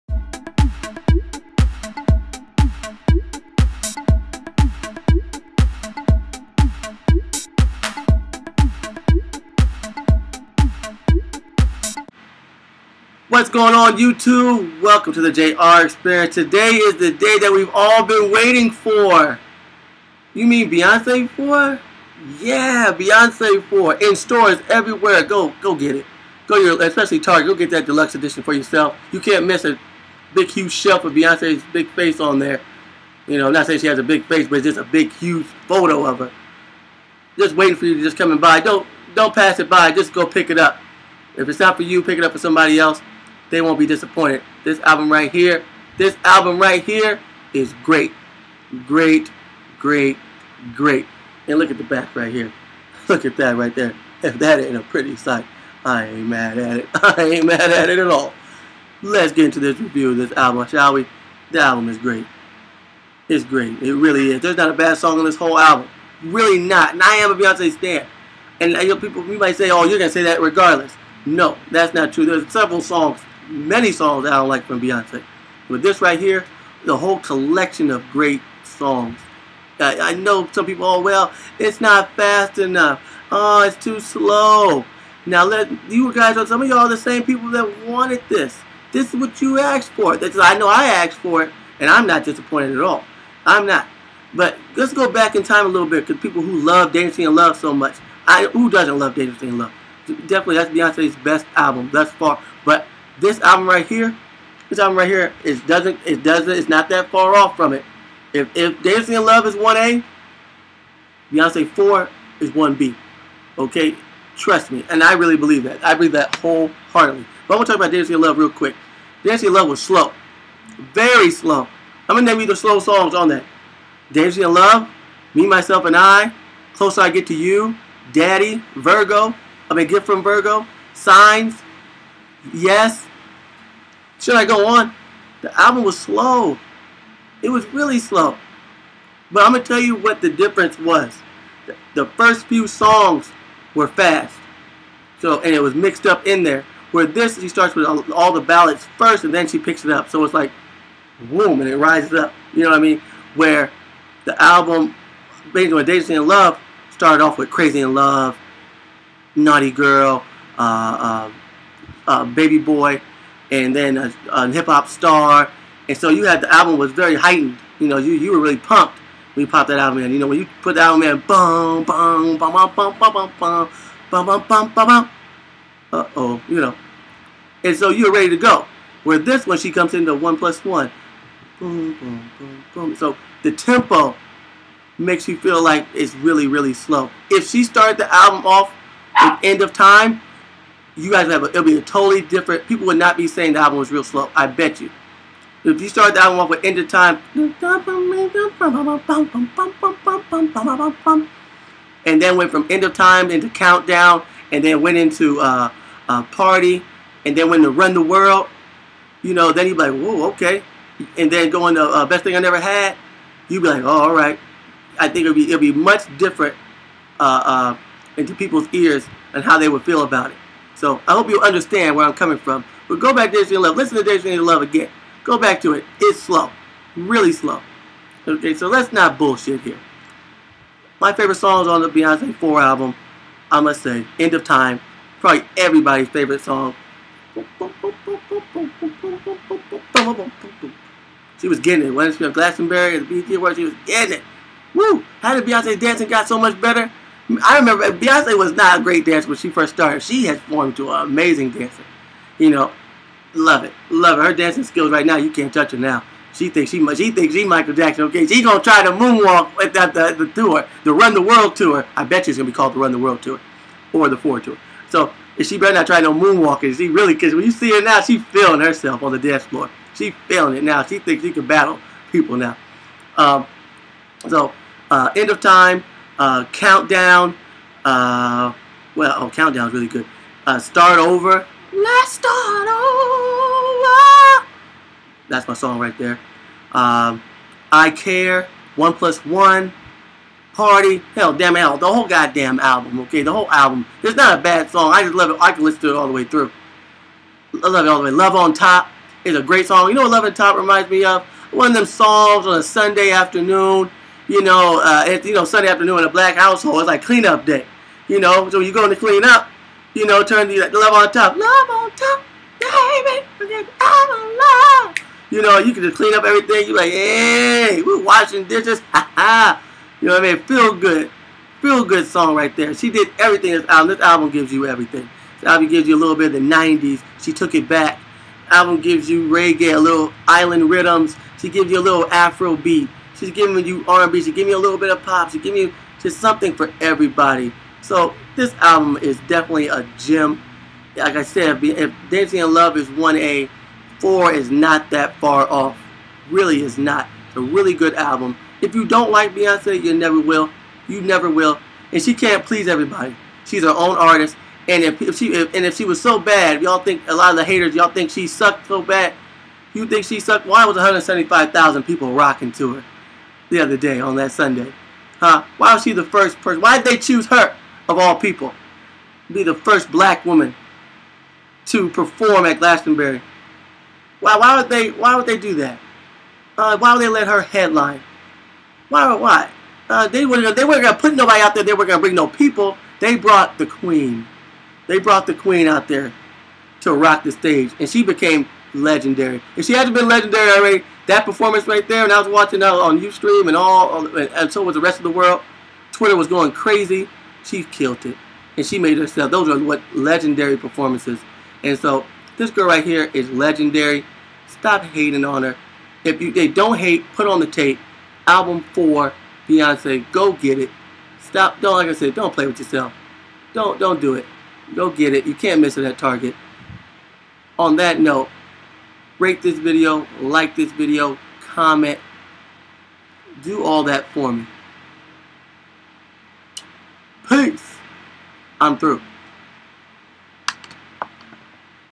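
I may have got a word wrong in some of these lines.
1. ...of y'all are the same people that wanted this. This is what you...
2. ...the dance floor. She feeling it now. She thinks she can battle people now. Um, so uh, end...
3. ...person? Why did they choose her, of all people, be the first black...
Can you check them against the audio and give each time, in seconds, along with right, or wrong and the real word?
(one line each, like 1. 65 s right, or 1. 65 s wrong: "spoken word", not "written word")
1. 86 s right
2. 269 s right
3. 366 s right.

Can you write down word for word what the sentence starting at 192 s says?
People would not be saying the album was real slow.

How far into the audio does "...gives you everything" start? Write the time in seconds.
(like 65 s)
324 s.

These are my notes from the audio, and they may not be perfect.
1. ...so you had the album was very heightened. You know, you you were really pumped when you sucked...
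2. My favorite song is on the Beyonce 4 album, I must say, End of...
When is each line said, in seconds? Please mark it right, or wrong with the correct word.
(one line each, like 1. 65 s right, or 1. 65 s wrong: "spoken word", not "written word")
1. 165 s wrong: "popped", not "sucked"
2. 230 s right.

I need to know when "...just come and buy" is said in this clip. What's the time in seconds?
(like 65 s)
38 s.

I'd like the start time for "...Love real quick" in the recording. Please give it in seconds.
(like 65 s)
118 s.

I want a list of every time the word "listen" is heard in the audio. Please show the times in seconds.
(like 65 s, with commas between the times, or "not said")
223 s, 295 s.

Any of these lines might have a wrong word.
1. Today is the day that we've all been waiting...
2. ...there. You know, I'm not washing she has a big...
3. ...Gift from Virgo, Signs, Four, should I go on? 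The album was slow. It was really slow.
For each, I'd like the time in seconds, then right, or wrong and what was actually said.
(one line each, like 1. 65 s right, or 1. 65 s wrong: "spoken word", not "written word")
1. 16 s right
2. 32 s wrong: "saying", not "washing"
3. 129 s wrong: "Yes", not "Four".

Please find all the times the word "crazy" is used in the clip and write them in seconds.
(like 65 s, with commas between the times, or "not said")
157 s, 396 s.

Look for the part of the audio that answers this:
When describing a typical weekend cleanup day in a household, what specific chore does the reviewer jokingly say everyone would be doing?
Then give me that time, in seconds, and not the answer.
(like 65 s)
318 s.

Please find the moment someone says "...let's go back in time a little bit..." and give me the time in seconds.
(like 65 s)
94 s.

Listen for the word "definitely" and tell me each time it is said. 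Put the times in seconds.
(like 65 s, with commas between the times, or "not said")
100 s, 339 s.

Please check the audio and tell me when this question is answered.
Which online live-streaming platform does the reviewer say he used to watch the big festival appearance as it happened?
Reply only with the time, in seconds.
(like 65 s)
392 s.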